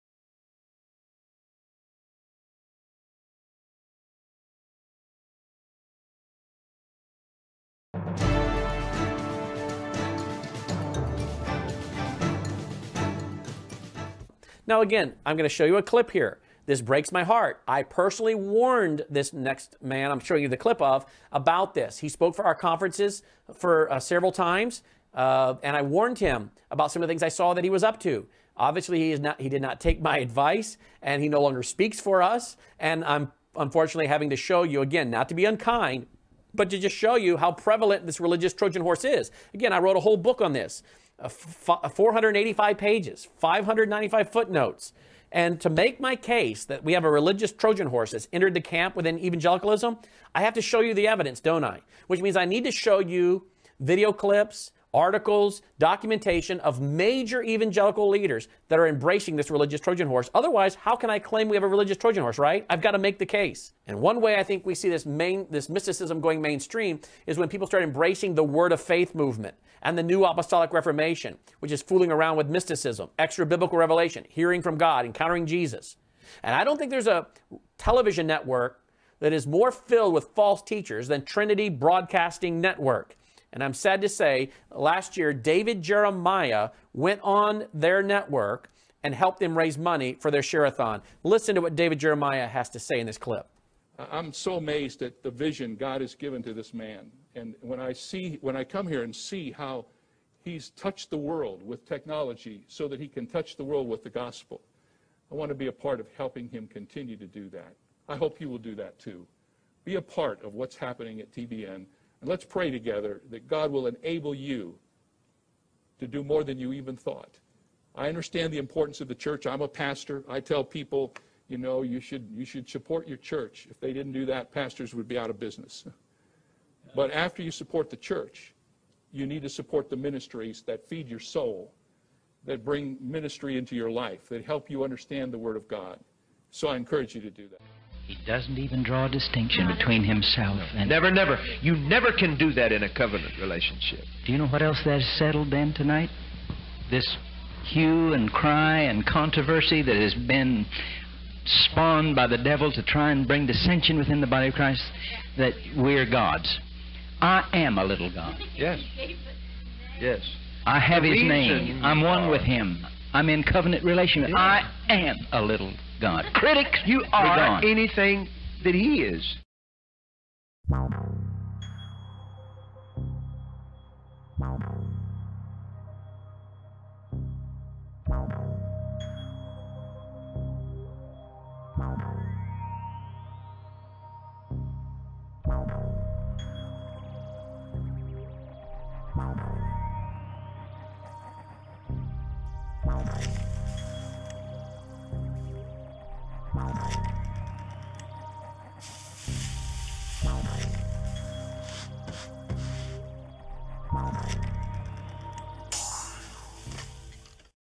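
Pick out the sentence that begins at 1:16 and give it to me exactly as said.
And I don't think there's a television network that is more filled with false teachers than Trinity Broadcasting Network.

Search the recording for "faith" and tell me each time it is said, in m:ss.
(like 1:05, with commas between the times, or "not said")
1:08.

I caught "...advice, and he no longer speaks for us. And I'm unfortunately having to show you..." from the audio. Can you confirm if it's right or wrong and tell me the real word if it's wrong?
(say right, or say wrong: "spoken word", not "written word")
right.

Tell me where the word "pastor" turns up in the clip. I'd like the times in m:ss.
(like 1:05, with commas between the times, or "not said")
1:59, 2:04.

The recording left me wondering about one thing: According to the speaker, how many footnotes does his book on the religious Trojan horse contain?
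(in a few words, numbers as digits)
595.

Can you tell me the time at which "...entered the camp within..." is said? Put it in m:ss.
0:48.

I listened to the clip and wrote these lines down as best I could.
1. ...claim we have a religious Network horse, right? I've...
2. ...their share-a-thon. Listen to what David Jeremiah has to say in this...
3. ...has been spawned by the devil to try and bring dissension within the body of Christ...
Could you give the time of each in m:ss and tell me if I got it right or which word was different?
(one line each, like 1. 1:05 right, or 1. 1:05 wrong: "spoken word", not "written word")
1. 1:01 wrong: "Trojan", not "Network"
2. 1:30 right
3. 2:29 right.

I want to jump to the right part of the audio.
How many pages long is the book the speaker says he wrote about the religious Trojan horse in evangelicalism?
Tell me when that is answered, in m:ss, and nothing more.
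0:41.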